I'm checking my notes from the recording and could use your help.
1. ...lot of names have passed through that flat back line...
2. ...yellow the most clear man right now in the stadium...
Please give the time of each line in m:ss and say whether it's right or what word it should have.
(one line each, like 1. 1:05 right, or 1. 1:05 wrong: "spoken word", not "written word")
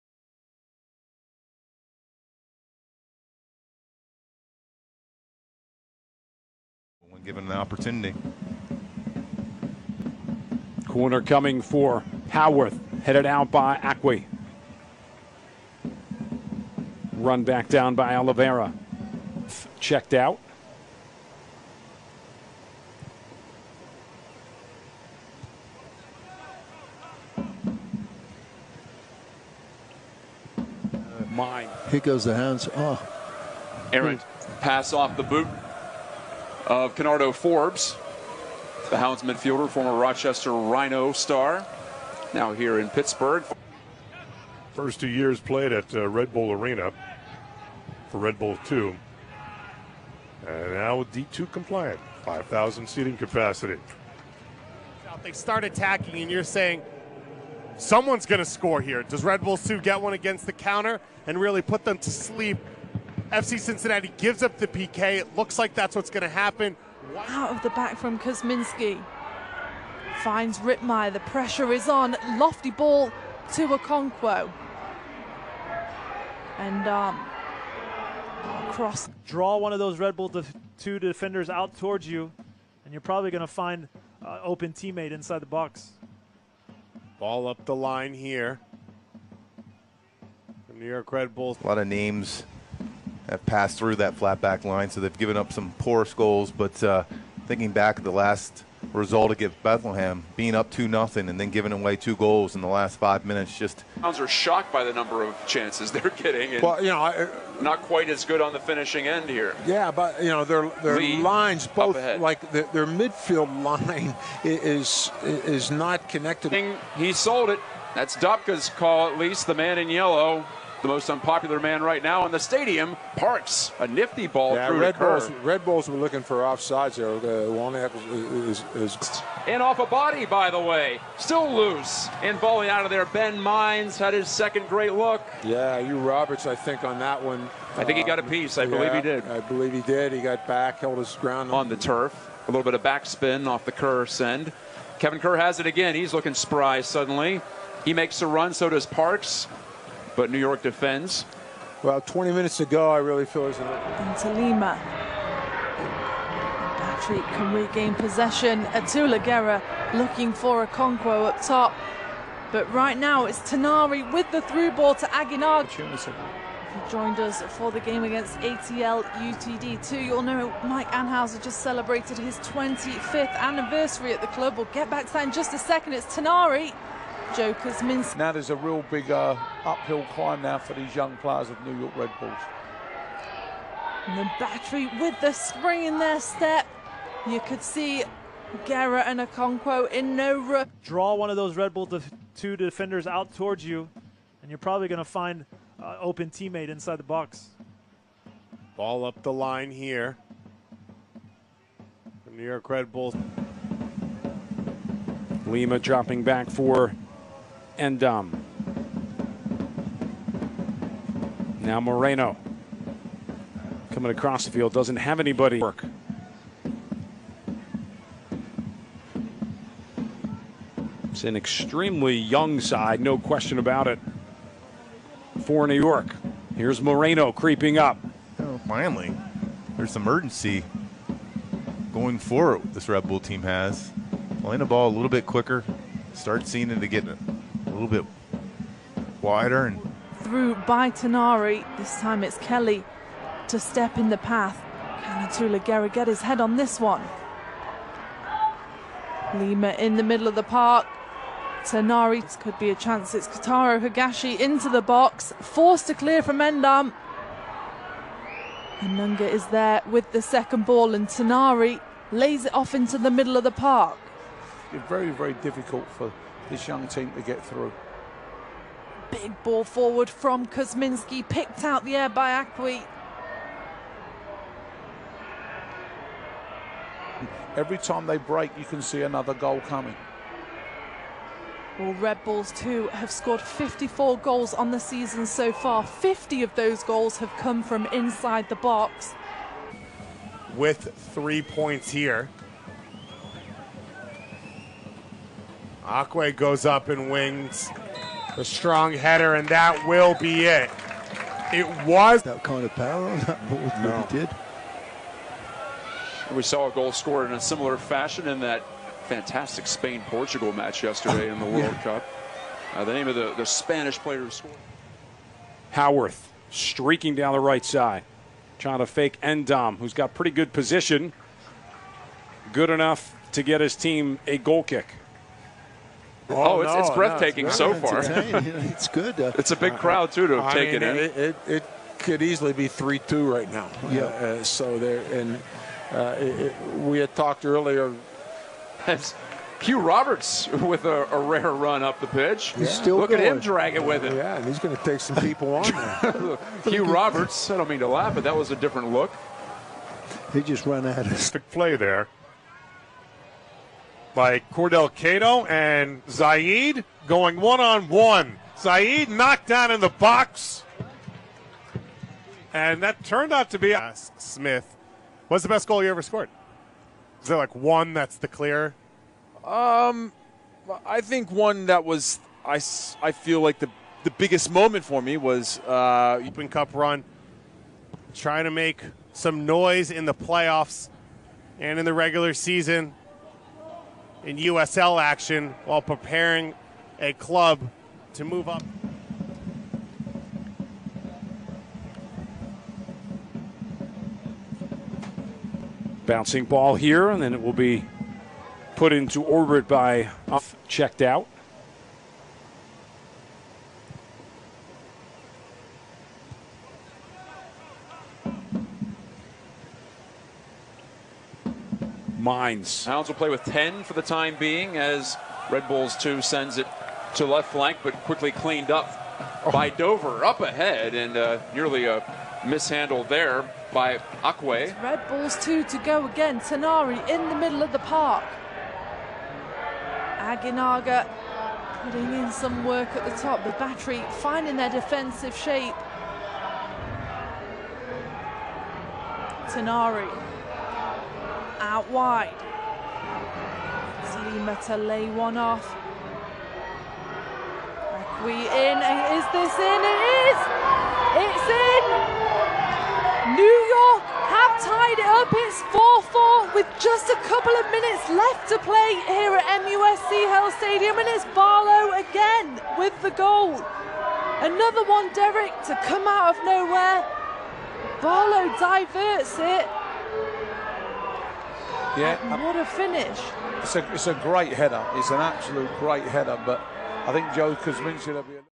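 1. 1:31 right
2. 1:59 wrong: "unpopular", not "clear".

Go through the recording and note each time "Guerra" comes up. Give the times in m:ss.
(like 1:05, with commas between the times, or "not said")
2:39, 3:08, 4:05.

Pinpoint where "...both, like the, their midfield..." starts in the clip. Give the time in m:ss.
1:51.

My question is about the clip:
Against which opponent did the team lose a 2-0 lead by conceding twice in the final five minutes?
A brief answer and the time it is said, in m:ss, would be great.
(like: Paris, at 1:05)
Bethlehem, at 1:39.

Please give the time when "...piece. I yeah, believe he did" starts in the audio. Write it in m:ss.
2:18.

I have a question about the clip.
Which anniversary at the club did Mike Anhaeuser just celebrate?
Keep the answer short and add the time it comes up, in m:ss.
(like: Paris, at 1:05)
25th, at 2:52.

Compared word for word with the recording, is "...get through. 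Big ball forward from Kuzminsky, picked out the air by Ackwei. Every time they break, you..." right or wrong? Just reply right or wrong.
right.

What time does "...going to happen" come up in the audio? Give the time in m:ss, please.
1:06.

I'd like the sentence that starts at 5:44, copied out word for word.
Yeah, and he's going to take some people on there.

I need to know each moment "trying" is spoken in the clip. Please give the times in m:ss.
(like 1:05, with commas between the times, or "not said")
5:18, 6:18.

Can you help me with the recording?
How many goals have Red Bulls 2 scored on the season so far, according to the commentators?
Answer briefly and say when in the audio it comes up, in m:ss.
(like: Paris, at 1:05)
54, at 4:43.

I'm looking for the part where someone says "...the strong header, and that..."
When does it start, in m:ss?
4:58.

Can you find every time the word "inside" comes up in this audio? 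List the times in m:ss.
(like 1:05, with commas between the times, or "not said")
1:25, 3:16, 4:47.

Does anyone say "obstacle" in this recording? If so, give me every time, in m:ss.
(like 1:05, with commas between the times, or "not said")
not said.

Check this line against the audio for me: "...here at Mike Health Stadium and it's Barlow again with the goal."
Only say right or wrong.
wrong.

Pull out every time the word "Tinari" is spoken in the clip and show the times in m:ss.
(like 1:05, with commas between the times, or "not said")
2:43, 2:56, 4:00, 4:11, 4:21, 7:06, 7:19.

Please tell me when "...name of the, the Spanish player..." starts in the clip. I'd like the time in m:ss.
5:12.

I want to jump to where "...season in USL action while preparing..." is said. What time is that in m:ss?
6:22.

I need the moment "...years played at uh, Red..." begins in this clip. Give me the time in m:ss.
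0:45.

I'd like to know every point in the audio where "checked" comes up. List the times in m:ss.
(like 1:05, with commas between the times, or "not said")
0:19, 6:40.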